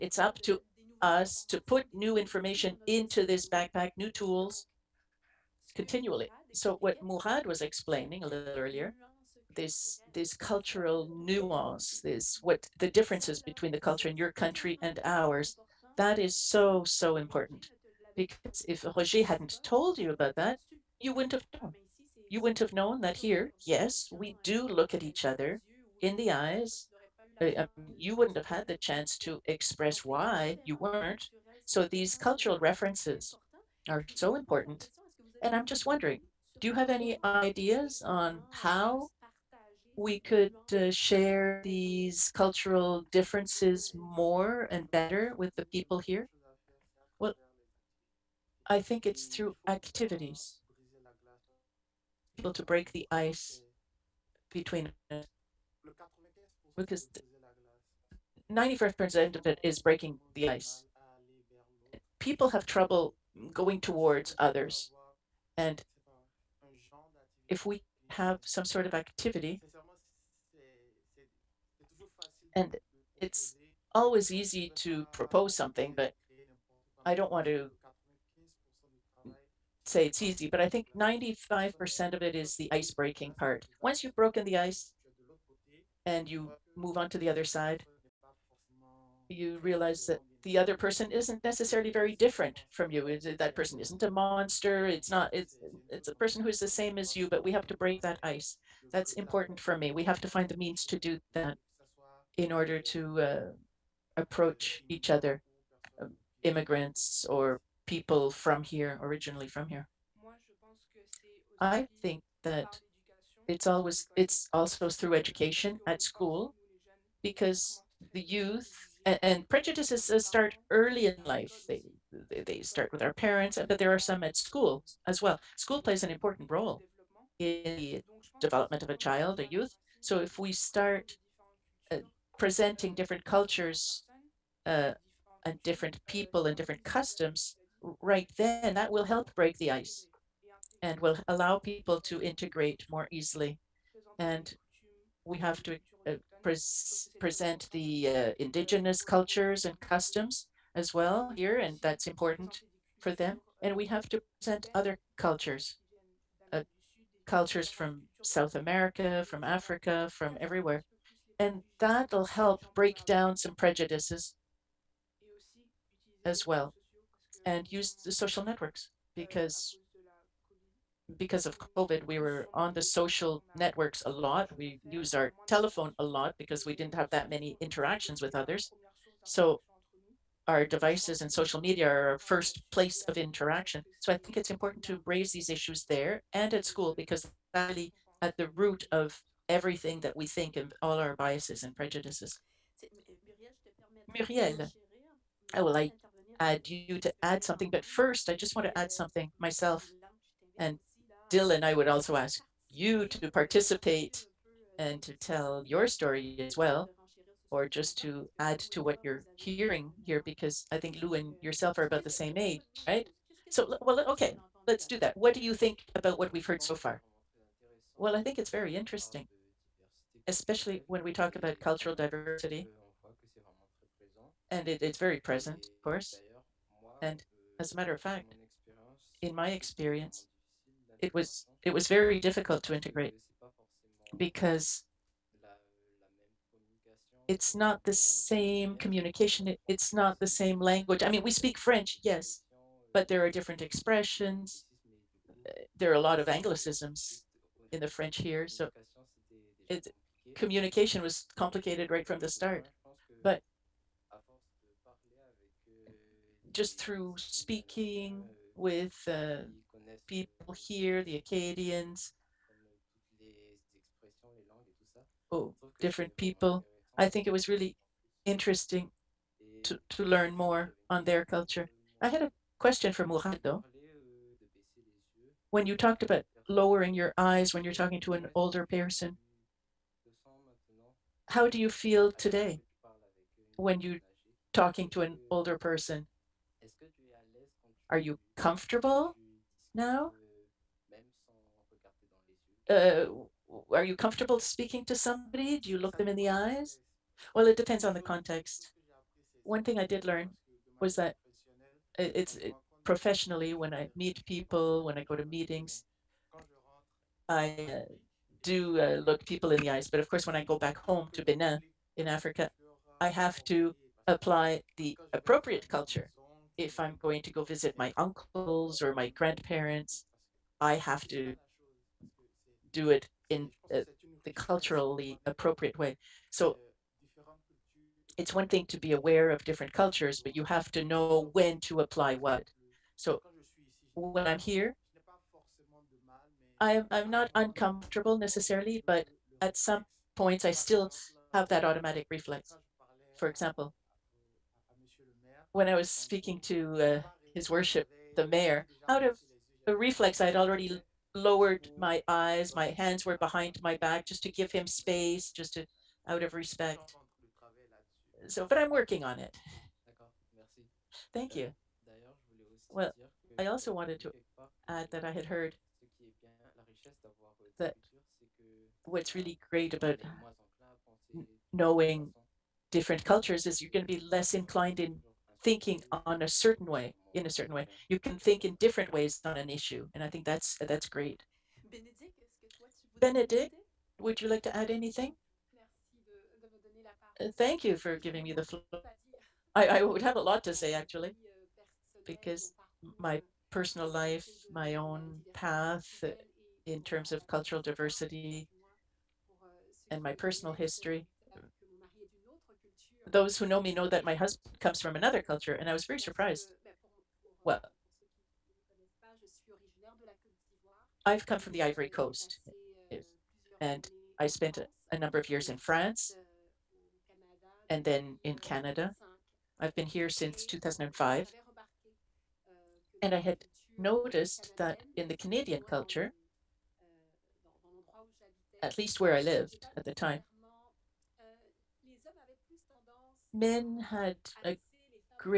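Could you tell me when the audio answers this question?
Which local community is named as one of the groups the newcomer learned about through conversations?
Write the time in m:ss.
4:21.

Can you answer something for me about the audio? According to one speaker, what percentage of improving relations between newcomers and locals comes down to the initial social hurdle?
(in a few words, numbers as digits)
95%.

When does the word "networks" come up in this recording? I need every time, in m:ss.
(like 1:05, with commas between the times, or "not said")
2:48, 2:53.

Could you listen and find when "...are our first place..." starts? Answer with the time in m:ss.
3:01.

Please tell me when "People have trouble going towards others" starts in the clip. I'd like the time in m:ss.
1:02.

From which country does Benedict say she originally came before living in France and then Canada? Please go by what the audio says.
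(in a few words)
Ivory Coast.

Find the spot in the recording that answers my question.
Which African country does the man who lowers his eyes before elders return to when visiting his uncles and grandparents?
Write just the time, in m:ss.
5:11.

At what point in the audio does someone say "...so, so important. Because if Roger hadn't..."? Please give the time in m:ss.
0:16.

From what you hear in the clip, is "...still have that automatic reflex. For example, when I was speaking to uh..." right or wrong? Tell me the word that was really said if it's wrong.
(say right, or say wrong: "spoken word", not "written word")
right.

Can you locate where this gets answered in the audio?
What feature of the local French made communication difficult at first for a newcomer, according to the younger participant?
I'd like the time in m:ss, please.
4:06.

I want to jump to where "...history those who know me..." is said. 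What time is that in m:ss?
6:40.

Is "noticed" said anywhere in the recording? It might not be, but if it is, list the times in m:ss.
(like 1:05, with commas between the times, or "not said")
7:03.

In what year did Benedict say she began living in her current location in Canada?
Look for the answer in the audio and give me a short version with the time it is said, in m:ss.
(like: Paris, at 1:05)
2005, at 7:00.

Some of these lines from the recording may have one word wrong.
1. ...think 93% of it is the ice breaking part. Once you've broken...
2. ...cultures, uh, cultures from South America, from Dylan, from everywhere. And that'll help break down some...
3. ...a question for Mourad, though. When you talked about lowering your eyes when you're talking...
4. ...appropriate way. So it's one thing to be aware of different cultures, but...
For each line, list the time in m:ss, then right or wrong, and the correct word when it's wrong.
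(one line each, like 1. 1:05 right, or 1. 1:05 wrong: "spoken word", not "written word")
1. 1:20 wrong: "95", not "93"
2. 2:35 wrong: "Africa", not "Dylan"
3. 4:32 right
4. 5:25 right.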